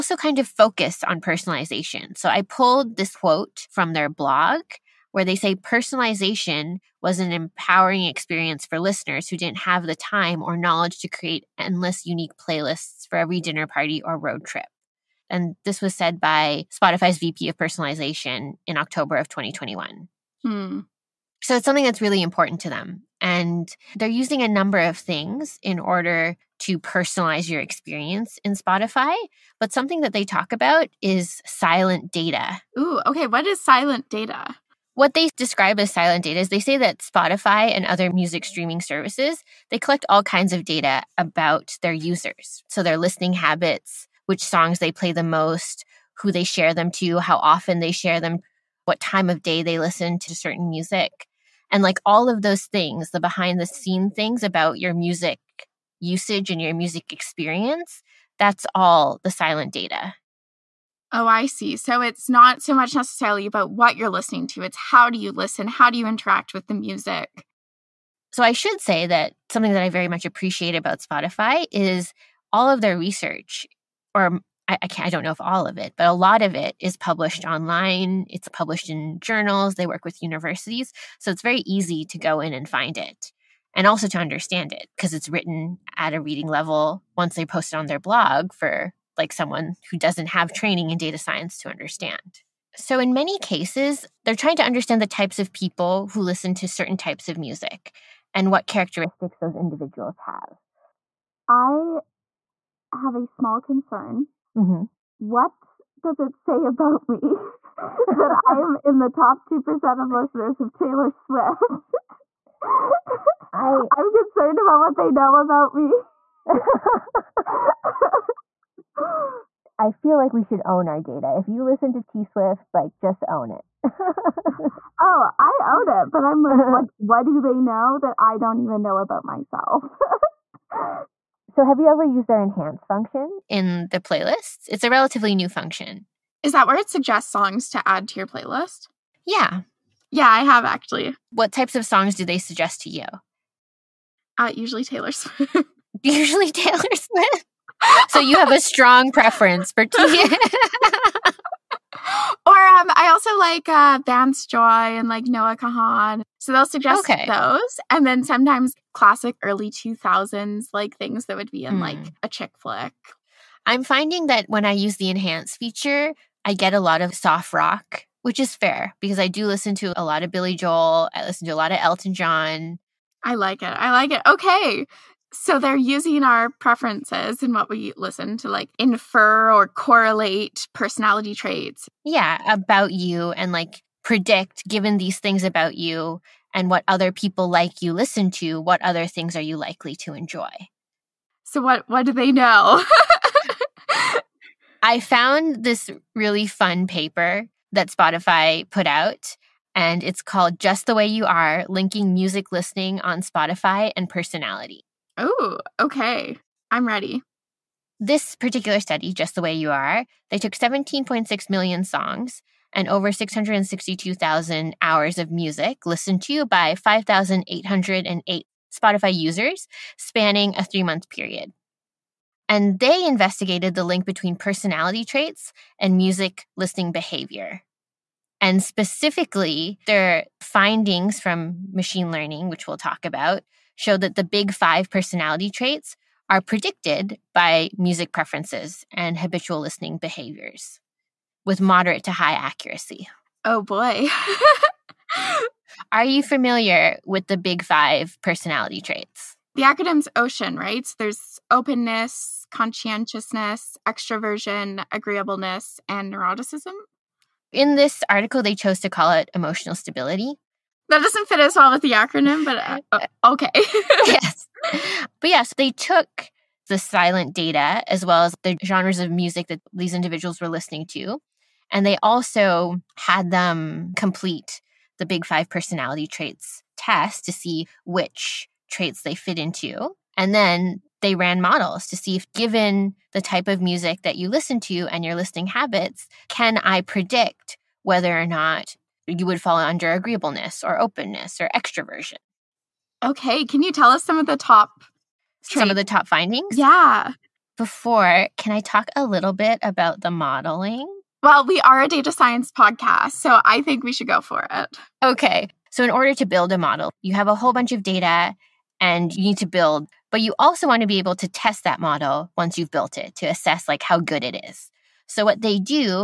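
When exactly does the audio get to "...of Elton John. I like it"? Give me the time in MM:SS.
02:51.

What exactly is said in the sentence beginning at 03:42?
And they investigated the link between personality traits and music listening behavior.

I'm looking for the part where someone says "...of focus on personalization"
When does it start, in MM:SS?
00:00.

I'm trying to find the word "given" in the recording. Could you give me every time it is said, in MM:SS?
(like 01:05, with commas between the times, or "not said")
03:04, 04:42.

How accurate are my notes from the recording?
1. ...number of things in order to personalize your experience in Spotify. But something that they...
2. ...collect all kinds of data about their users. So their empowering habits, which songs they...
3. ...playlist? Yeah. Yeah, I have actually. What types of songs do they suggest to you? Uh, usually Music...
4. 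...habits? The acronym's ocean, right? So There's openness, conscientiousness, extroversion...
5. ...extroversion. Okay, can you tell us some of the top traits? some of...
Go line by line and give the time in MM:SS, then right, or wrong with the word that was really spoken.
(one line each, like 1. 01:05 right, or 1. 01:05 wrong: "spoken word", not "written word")
1. 00:24 right
2. 00:39 wrong: "listening", not "empowering"
3. 02:18 wrong: "Taylor", not "Music"
4. 04:08 wrong: "traits", not "habits"
5. 04:51 right.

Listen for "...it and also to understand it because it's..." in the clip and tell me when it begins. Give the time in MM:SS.
01:22.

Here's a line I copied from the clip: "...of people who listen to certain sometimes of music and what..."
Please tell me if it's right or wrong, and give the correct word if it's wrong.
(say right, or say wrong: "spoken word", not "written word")
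wrong: "types", not "sometimes".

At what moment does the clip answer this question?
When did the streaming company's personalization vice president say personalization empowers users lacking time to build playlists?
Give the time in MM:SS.
00:18.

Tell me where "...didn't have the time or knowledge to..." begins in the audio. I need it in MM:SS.
00:09.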